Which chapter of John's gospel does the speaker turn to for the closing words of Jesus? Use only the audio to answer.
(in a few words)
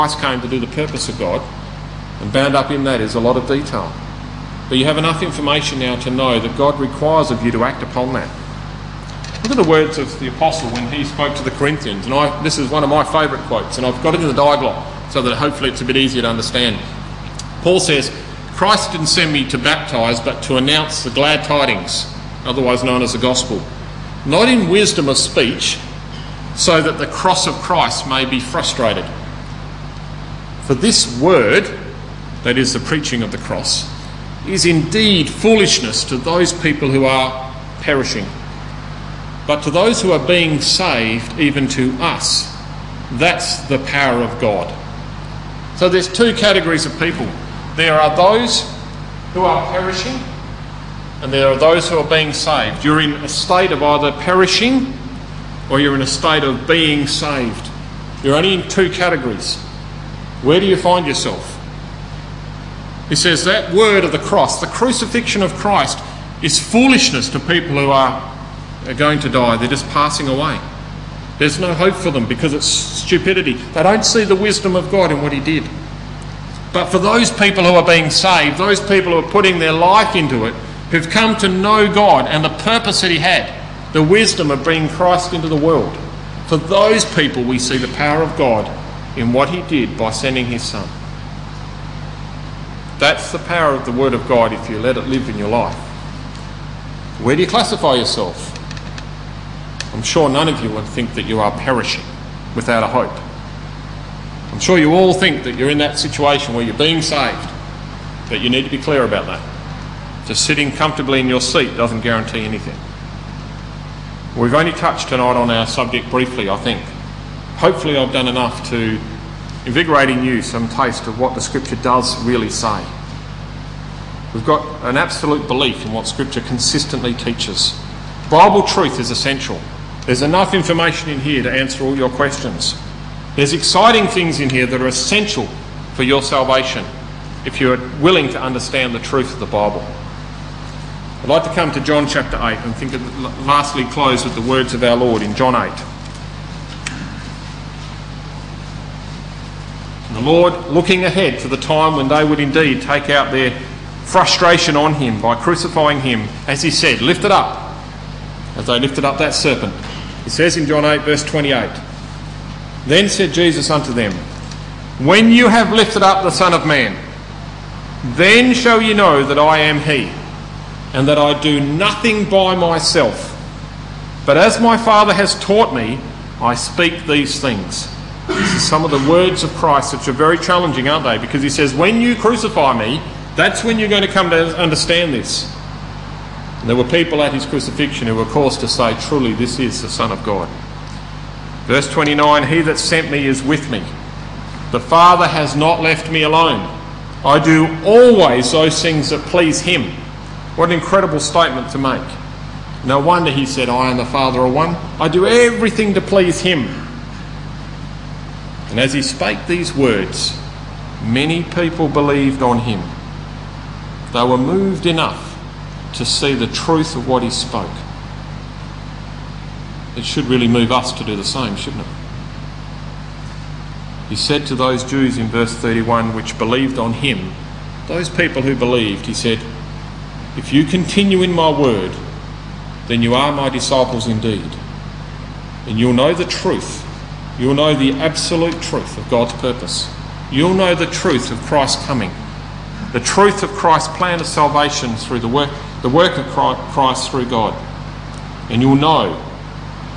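8.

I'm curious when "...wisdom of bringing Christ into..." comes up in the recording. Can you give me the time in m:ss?
1:24.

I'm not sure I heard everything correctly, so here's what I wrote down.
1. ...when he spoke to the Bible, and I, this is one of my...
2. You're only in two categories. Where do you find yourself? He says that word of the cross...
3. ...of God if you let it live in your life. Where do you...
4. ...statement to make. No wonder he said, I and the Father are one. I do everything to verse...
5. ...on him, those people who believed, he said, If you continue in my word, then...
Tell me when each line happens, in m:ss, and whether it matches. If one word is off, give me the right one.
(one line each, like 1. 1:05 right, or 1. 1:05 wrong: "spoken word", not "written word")
1. 0:10 wrong: "Corinthians", not "Bible"
2. 0:58 right
3. 1:34 right
4. 3:21 wrong: "please", not "verse"
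5. 3:46 right.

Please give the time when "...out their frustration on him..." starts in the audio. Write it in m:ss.
2:33.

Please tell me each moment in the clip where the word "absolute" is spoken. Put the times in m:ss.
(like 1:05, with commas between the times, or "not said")
2:04, 3:57.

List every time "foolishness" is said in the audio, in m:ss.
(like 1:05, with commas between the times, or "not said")
0:35, 1:06.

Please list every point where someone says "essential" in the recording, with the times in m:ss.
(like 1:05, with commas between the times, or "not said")
2:09, 2:14.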